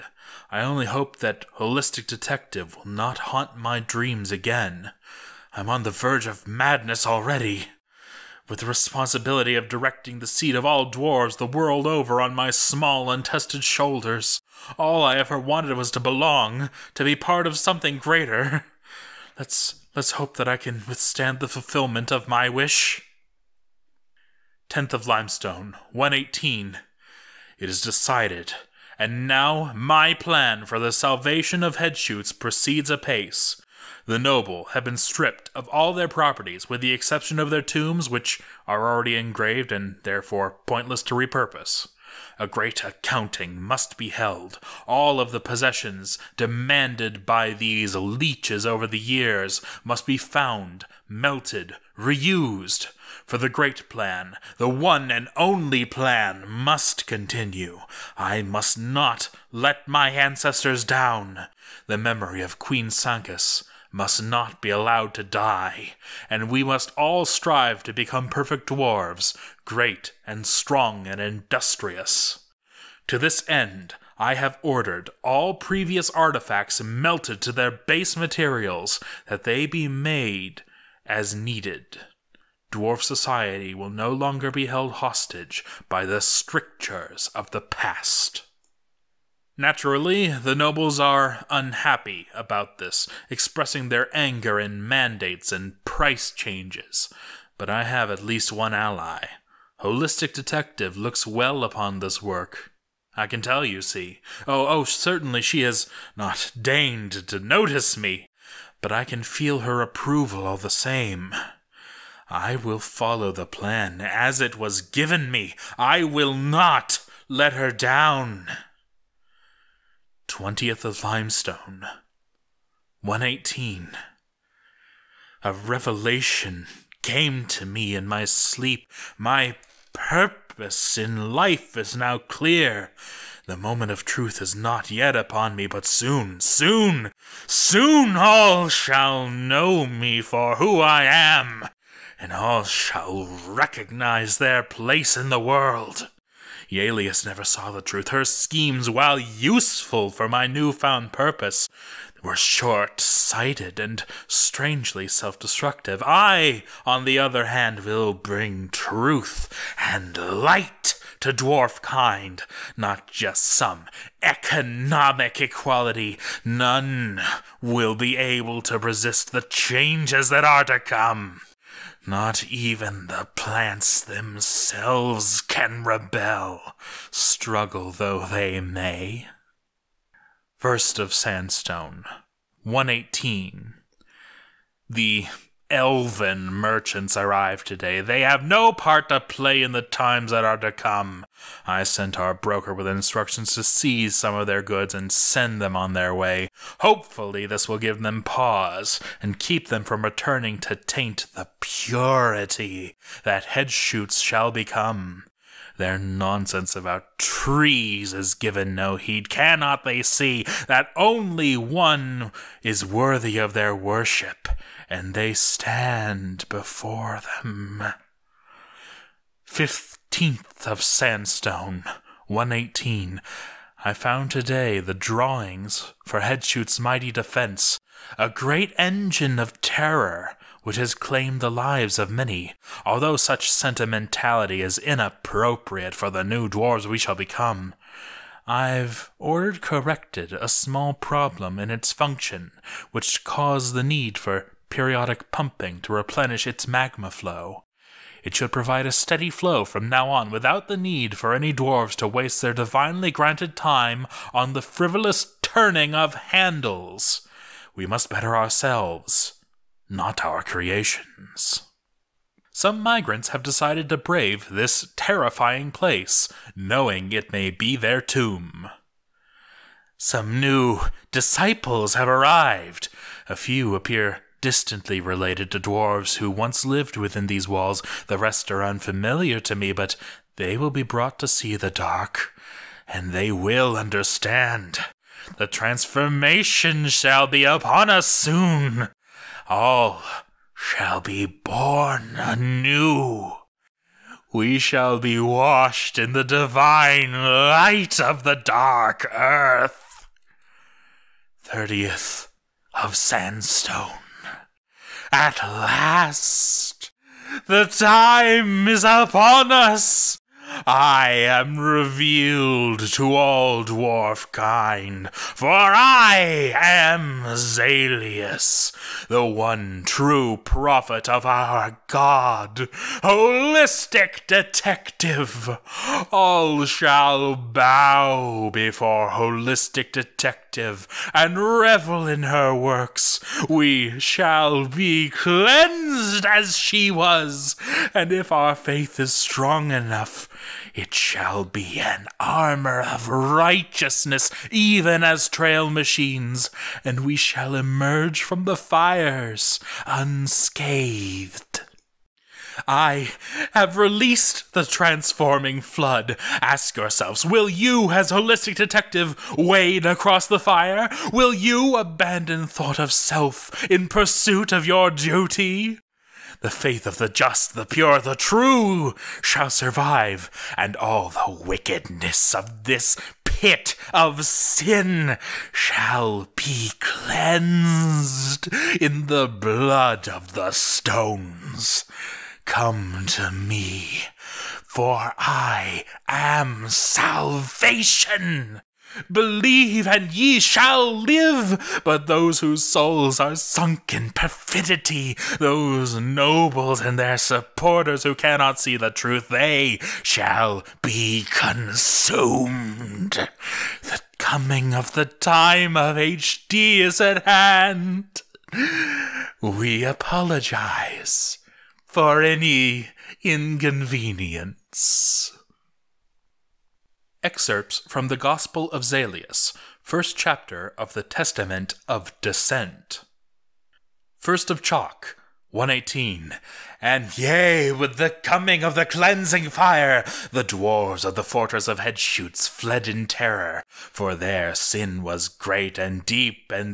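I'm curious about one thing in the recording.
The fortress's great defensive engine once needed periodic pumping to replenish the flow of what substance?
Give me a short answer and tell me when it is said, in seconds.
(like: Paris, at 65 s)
Magma, at 246 s.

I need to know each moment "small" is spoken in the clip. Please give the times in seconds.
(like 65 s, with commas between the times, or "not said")
12 s, 240 s.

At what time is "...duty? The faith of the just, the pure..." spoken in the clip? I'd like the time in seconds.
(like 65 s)
364 s.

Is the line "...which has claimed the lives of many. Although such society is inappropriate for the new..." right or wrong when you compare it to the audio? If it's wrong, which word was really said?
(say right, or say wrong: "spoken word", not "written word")
wrong: "sentimentality", not "society".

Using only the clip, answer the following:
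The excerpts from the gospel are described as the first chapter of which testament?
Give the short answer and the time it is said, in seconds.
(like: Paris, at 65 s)
Testament of Descent, at 421 s.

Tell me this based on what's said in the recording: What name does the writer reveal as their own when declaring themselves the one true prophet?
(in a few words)
Zalius.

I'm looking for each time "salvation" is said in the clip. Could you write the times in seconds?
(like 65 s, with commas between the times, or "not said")
30 s, 386 s.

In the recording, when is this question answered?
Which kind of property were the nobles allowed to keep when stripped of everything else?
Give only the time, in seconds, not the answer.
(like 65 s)
37 s.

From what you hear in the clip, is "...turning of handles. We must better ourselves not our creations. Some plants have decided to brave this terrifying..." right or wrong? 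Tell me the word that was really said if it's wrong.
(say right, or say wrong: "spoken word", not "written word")
wrong: "migrants", not "plants".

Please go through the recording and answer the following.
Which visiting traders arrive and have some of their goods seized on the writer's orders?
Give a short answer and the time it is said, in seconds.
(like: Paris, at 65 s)
Elven merchants, at 185 s.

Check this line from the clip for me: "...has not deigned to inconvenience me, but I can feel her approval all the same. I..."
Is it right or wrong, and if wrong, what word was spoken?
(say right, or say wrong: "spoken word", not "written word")
wrong: "notice", not "inconvenience".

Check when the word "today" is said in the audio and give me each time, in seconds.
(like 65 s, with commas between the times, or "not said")
187 s, 224 s.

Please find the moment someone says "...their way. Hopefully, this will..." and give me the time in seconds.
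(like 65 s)
195 s.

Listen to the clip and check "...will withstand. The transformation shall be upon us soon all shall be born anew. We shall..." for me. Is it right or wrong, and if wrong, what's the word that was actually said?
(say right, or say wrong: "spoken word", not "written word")
wrong: "understand", not "withstand".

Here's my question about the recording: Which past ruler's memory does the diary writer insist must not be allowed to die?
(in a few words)
Queen Sancus.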